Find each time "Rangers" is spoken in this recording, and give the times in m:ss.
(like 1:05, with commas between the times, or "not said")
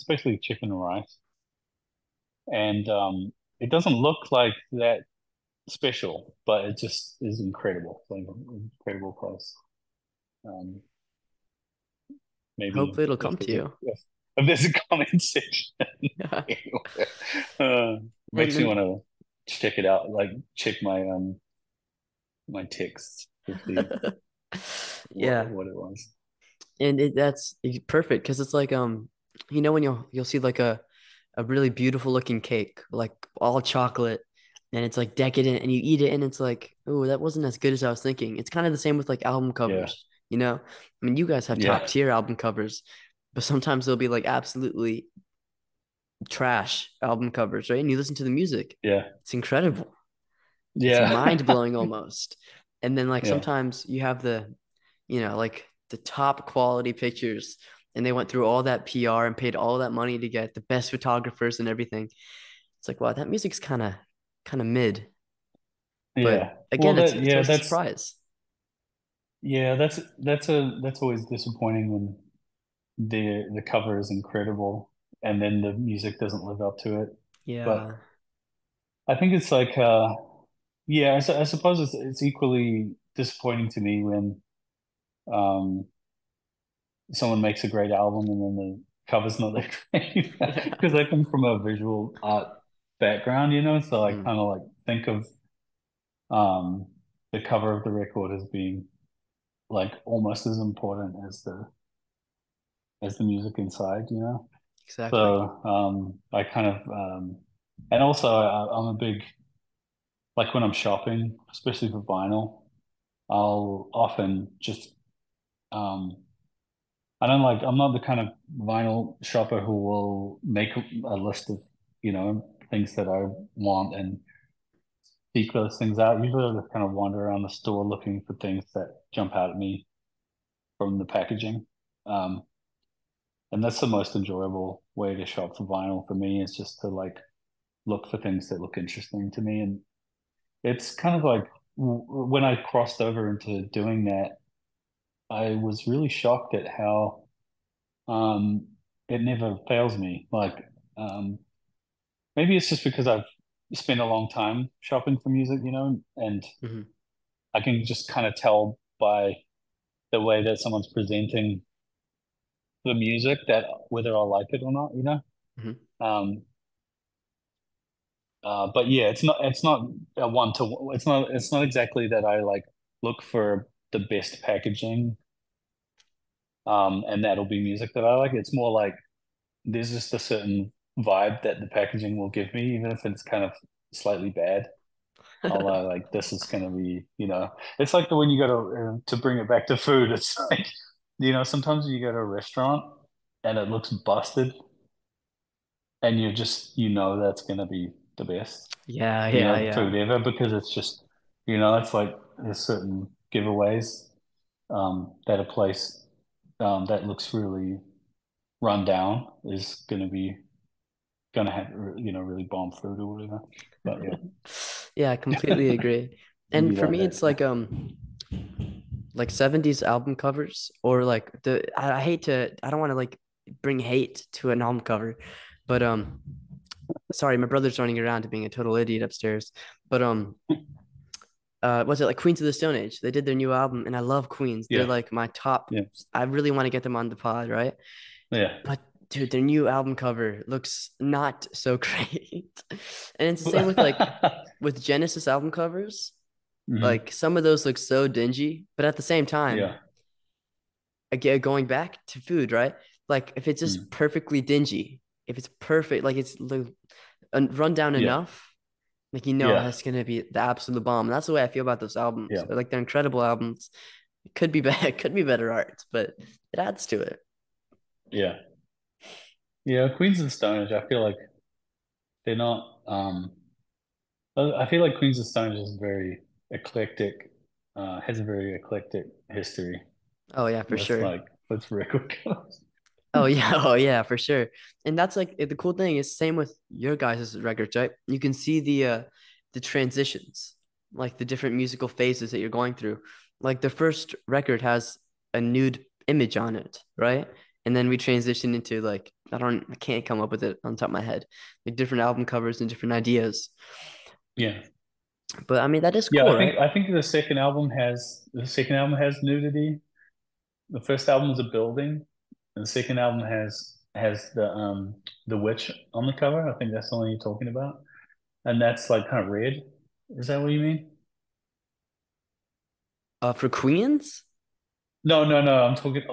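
not said.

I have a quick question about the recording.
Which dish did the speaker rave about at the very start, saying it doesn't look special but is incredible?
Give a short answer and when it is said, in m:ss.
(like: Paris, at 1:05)
chicken and rice, at 0:00.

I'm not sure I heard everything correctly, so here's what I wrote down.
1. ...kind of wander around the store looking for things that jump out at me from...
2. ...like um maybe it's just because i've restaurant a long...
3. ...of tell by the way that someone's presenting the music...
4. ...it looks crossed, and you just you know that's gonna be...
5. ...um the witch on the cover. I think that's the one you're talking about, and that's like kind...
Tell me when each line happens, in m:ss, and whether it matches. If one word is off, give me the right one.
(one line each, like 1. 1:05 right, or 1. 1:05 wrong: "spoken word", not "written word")
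1. 2:06 right
2. 2:30 wrong: "spent", not "restaurant"
3. 2:38 right
4. 3:13 wrong: "busted", not "crossed"
5. 5:14 right.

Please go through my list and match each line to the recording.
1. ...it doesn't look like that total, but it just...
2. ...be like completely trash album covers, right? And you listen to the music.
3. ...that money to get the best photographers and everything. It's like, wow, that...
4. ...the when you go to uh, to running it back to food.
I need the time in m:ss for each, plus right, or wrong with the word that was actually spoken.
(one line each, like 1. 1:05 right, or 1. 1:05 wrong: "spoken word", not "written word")
1. 0:03 wrong: "special", not "total"
2. 0:43 wrong: "absolutely", not "completely"
3. 0:59 right
4. 3:08 wrong: "bring", not "running".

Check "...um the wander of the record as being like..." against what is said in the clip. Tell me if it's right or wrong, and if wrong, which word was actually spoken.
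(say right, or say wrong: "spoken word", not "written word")
wrong: "cover", not "wander".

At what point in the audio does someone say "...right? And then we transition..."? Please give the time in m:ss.
4:56.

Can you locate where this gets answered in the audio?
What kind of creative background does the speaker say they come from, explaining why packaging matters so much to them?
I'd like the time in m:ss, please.
1:31.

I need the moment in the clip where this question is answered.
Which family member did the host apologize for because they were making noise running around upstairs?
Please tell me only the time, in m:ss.
3:47.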